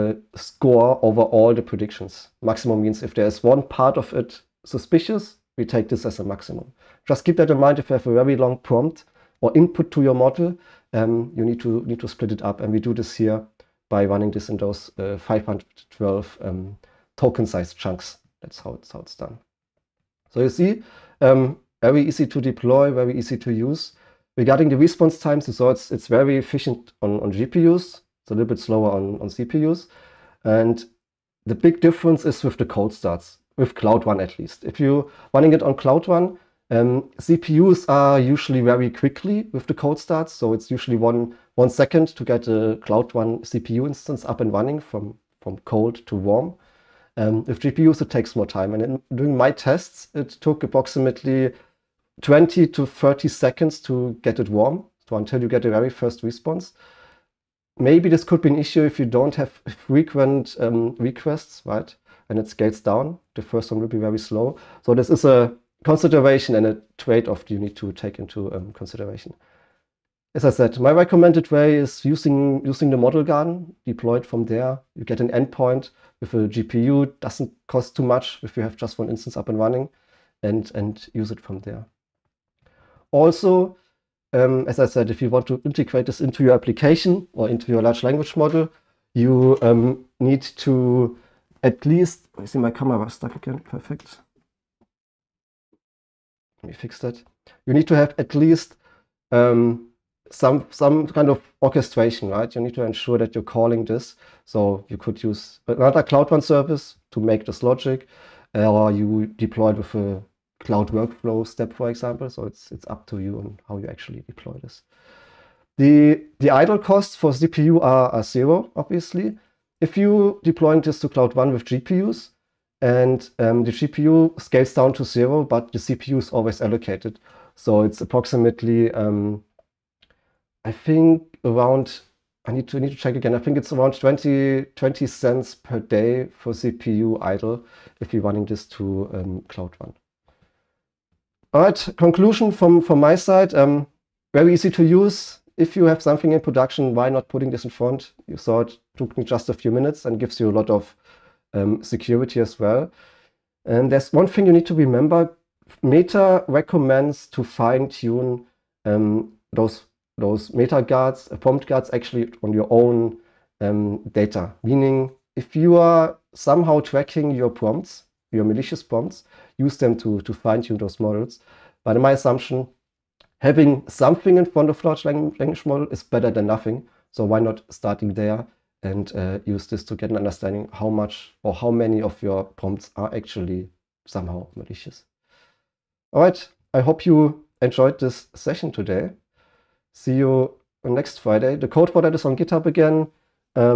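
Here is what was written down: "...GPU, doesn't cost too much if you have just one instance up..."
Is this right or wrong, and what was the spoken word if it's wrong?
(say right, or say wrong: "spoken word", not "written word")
right.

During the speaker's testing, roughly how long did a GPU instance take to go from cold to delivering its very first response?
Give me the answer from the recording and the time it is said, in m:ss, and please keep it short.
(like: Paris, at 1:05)
20 to 30 seconds, at 0:52.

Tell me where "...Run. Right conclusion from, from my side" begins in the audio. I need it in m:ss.
2:19.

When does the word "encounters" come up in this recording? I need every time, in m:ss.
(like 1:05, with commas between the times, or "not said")
not said.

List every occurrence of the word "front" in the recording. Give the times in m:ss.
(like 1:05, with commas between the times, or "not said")
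2:27, 2:54.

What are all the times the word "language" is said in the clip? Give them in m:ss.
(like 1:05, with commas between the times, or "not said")
1:28, 2:55.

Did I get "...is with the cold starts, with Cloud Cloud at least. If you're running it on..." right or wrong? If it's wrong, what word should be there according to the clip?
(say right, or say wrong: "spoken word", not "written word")
wrong: "Run", not "Cloud".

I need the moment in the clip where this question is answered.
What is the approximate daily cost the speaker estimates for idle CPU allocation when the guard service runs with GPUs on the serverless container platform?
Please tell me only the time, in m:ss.
2:14.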